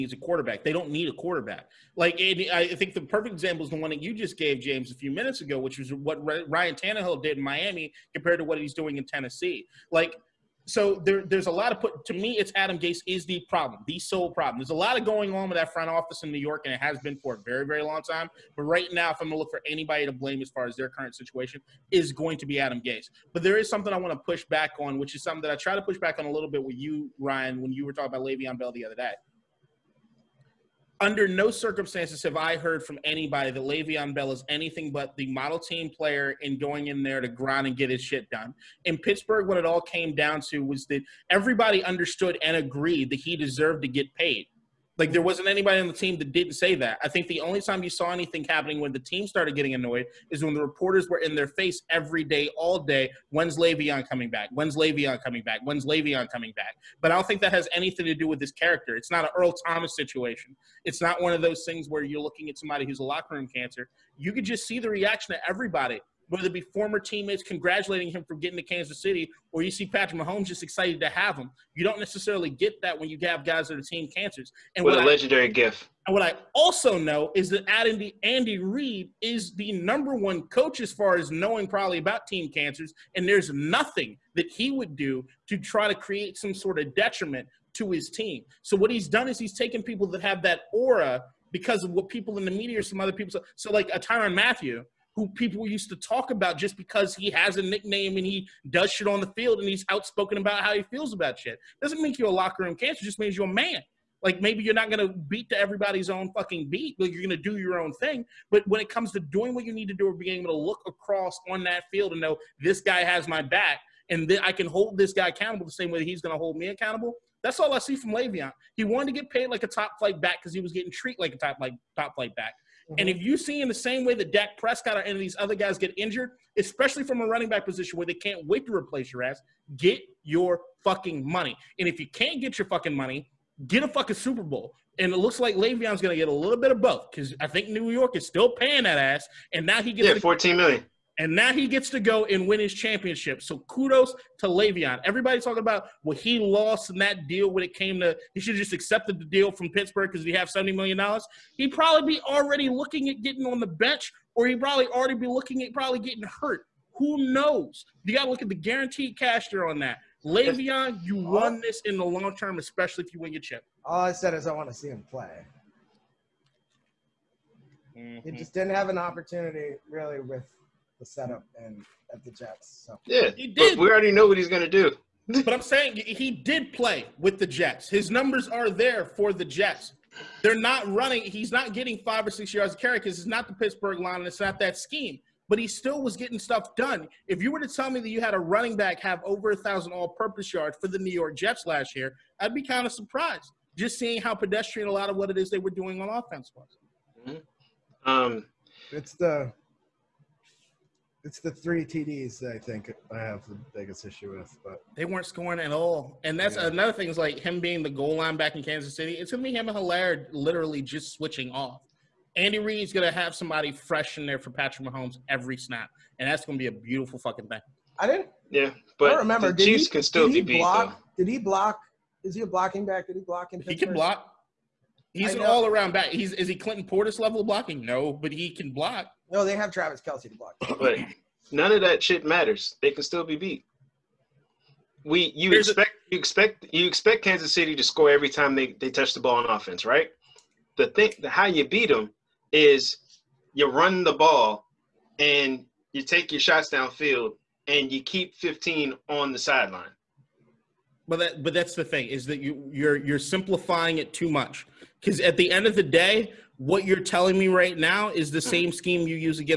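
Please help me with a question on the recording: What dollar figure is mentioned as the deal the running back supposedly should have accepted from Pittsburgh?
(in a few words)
$70 million.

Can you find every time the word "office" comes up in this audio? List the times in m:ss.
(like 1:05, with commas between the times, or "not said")
0:15.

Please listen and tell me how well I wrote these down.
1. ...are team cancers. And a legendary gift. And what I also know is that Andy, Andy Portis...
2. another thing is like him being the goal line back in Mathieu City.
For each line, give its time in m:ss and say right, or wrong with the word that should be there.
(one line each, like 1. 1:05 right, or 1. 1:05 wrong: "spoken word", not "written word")
1. 1:13 wrong: "Reid", not "Portis"
2. 3:26 wrong: "Kansas", not "Mathieu".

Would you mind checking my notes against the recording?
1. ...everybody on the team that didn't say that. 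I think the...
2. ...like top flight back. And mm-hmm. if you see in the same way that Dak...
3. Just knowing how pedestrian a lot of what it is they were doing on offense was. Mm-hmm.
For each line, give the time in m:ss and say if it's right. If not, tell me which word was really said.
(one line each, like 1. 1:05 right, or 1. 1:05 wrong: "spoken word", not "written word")
1. 0:45 wrong: "anybody", not "everybody"
2. 2:01 right
3. 3:13 wrong: "seeing", not "knowing".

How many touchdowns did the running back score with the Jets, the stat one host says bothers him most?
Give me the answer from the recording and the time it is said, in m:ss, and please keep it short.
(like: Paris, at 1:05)
3, at 3:21.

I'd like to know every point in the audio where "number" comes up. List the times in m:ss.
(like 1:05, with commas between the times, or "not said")
1:19, 2:58.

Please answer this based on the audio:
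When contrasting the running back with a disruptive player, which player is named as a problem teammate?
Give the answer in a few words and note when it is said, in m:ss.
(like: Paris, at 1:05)
Earl Thomas, at 0:59.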